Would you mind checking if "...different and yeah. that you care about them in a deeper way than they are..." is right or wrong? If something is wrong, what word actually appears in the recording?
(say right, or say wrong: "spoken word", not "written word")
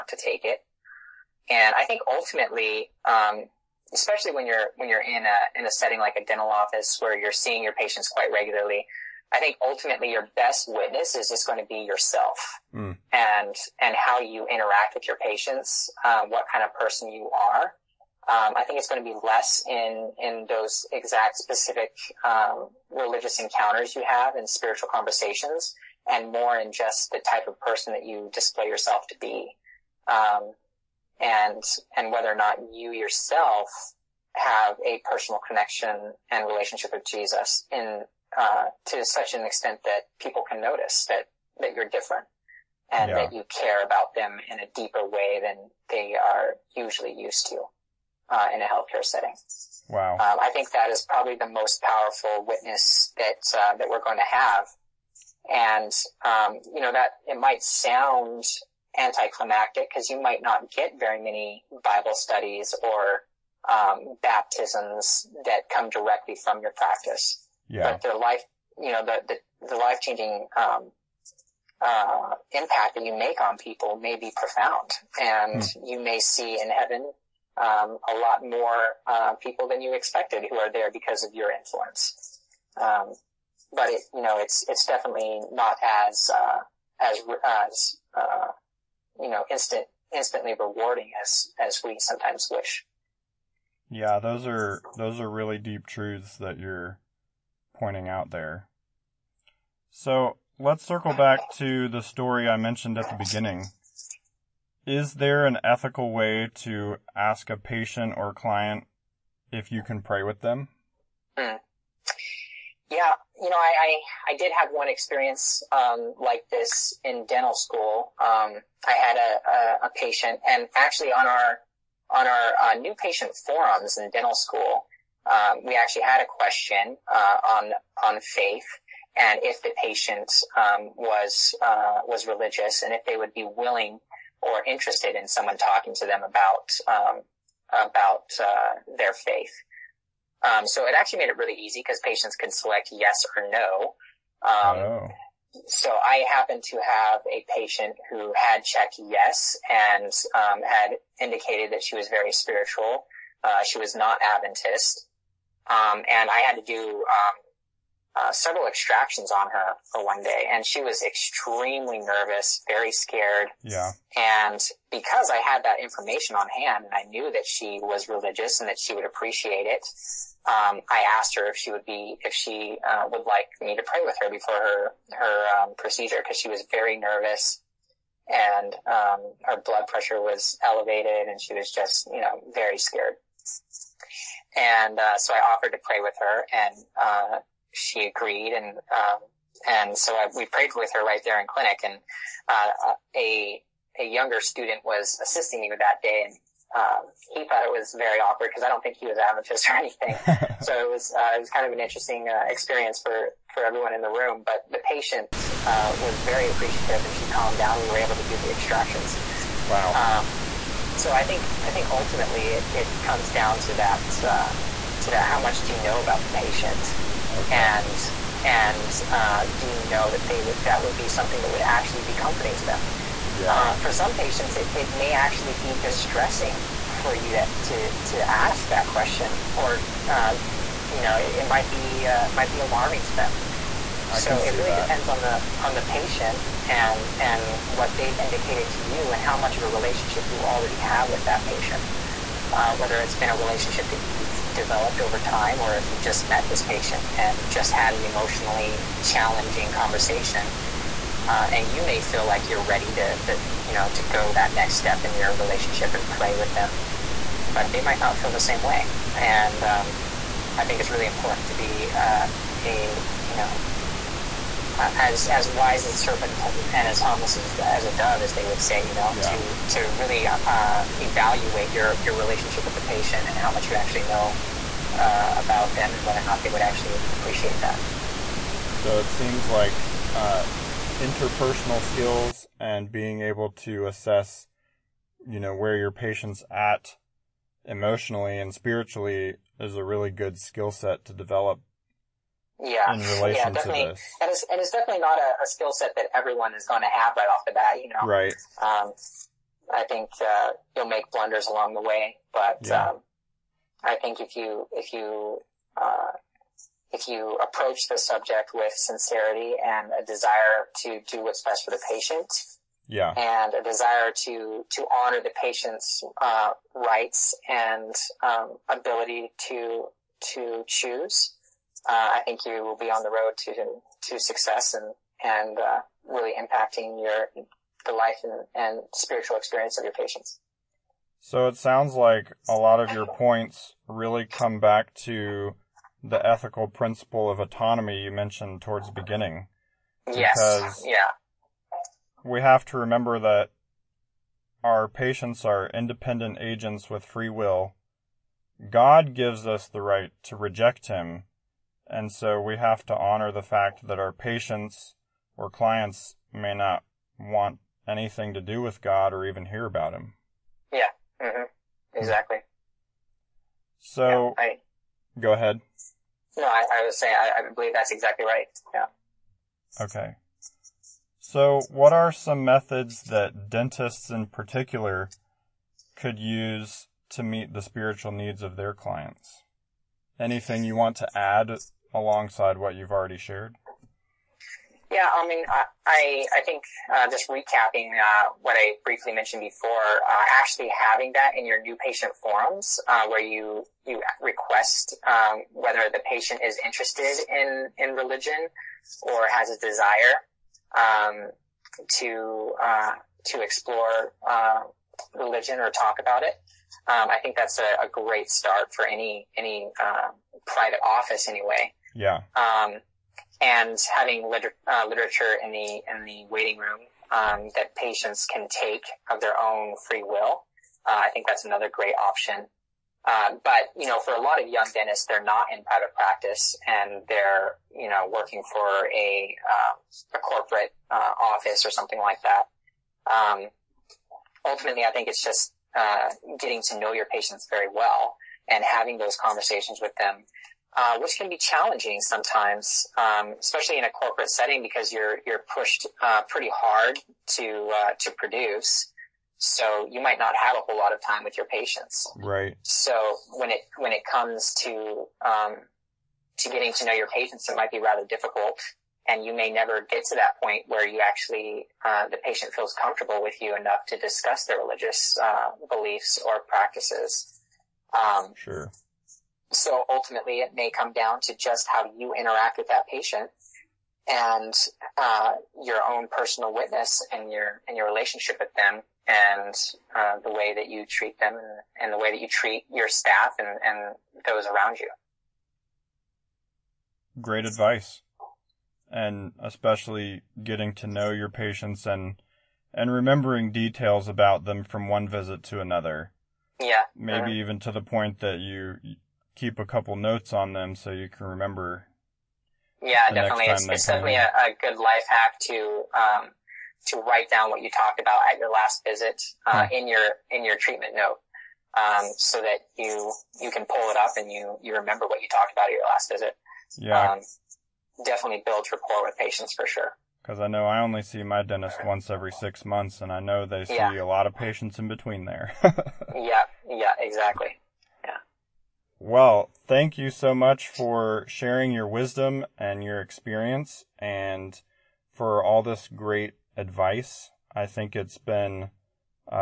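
right.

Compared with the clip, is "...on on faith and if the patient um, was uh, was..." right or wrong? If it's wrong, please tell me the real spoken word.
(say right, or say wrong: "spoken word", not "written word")
right.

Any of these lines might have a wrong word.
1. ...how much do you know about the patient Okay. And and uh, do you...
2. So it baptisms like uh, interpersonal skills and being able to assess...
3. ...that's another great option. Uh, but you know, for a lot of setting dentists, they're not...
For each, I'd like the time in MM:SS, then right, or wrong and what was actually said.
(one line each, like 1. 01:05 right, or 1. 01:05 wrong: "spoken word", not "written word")
1. 03:35 right
2. 04:38 wrong: "seems", not "baptisms"
3. 07:01 wrong: "young", not "setting".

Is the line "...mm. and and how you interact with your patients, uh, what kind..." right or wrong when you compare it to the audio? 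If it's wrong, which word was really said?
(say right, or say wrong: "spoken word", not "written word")
right.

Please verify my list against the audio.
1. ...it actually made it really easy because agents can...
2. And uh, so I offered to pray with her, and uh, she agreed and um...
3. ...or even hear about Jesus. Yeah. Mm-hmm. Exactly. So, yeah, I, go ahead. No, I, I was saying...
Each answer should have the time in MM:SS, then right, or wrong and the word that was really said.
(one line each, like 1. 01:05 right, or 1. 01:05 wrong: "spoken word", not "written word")
1. 02:20 wrong: "patients", not "agents"
2. 03:04 right
3. 05:59 wrong: "Him", not "Jesus".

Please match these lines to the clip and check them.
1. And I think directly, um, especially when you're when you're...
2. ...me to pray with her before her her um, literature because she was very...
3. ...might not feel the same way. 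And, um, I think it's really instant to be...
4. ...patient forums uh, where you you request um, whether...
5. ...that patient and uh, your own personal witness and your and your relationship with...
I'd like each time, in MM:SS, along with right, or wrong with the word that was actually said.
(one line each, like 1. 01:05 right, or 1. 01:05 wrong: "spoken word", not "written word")
1. 00:01 wrong: "ultimately", not "directly"
2. 02:53 wrong: "procedure", not "literature"
3. 04:17 wrong: "important", not "instant"
4. 06:31 right
5. 07:52 right.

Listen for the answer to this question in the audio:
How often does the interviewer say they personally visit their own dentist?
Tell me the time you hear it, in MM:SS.
08:41.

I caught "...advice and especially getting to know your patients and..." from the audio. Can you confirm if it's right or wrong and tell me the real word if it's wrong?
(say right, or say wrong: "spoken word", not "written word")
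right.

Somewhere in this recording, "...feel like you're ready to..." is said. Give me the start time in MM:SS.
04:12.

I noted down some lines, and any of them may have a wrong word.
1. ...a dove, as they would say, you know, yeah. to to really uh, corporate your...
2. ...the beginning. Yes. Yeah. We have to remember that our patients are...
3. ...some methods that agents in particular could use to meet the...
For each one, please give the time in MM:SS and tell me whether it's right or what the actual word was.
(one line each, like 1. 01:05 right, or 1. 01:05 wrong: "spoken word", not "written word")
1. 04:27 wrong: "evaluate", not "corporate"
2. 05:38 right
3. 06:12 wrong: "dentists", not "agents".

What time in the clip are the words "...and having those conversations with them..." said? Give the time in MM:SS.
07:18.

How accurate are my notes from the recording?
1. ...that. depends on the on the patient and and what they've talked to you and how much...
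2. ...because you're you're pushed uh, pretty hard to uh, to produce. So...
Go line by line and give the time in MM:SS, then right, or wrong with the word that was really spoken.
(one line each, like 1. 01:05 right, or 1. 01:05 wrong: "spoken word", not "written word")
1. 03:54 wrong: "indicated", not "talked"
2. 07:24 right.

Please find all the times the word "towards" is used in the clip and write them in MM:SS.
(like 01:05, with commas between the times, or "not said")
05:38.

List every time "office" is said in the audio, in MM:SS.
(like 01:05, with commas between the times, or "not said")
00:06, 06:50, 07:11.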